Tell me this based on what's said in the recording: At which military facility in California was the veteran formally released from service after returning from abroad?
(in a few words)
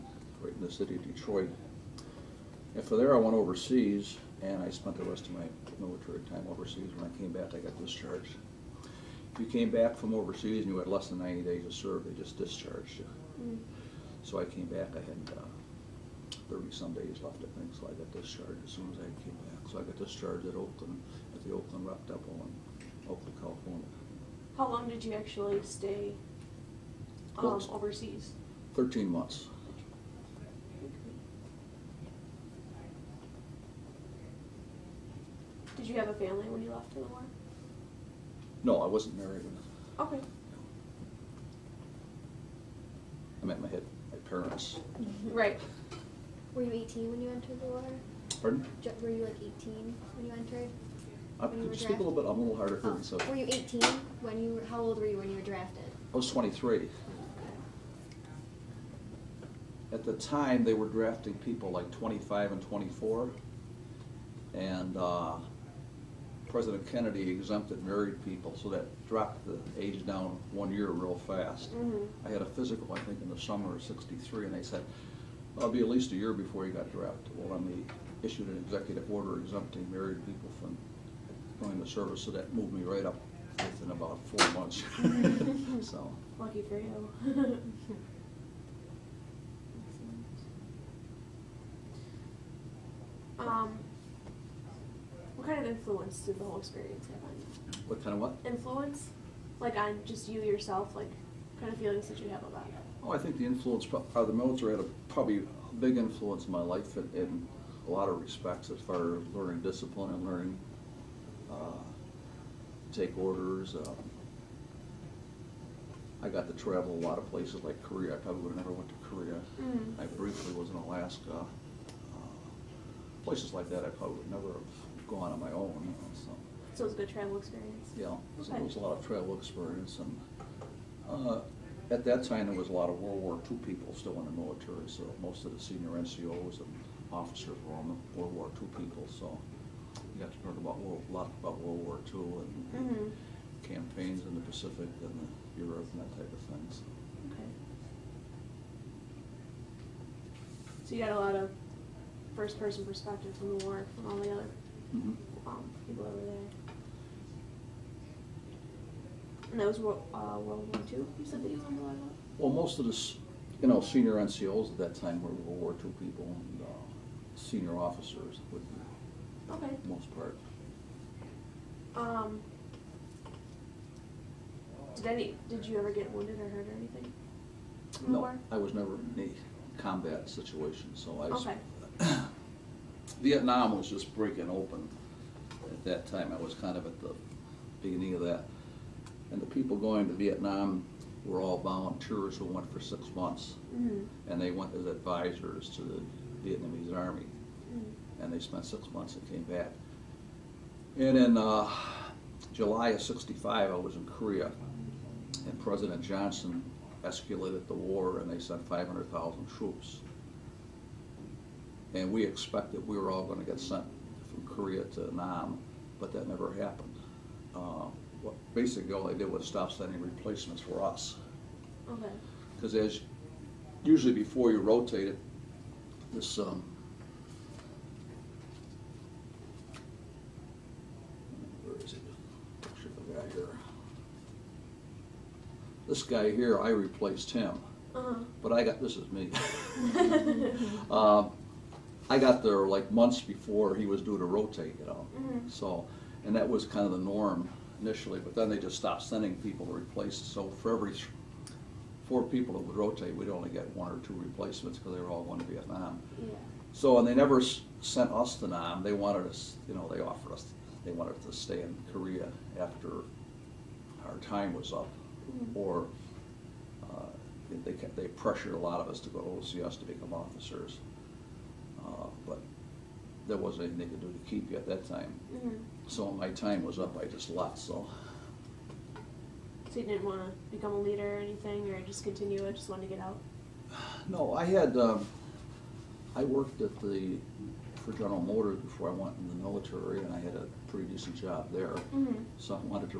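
Oakland Rep Depot.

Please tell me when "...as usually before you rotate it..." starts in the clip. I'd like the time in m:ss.
3:42.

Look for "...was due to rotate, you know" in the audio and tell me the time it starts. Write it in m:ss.
4:03.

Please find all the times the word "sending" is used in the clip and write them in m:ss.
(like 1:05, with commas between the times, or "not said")
3:39, 4:09.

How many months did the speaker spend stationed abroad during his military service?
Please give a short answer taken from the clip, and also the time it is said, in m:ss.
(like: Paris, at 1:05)
13 months, at 0:28.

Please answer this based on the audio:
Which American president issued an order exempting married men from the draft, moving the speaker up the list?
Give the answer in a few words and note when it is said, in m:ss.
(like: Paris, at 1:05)
Kennedy, at 1:06.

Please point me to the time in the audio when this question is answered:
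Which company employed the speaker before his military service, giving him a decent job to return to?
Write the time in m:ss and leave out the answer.
4:47.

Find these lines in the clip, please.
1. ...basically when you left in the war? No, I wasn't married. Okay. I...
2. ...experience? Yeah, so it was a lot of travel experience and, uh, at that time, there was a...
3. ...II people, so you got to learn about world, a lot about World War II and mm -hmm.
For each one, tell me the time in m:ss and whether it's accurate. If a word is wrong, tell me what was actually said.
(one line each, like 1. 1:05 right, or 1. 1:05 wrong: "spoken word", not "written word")
1. 0:36 wrong: "family", not "basically"
2. 2:07 right
3. 2:18 right.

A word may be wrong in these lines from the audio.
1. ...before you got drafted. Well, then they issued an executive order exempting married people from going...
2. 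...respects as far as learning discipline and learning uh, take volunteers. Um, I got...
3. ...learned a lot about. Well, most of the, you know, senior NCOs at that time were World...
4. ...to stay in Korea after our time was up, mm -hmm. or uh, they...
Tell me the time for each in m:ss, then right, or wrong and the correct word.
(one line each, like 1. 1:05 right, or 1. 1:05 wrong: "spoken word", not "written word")
1. 1:16 right
2. 1:48 wrong: "orders", not "volunteers"
3. 2:41 right
4. 4:21 right.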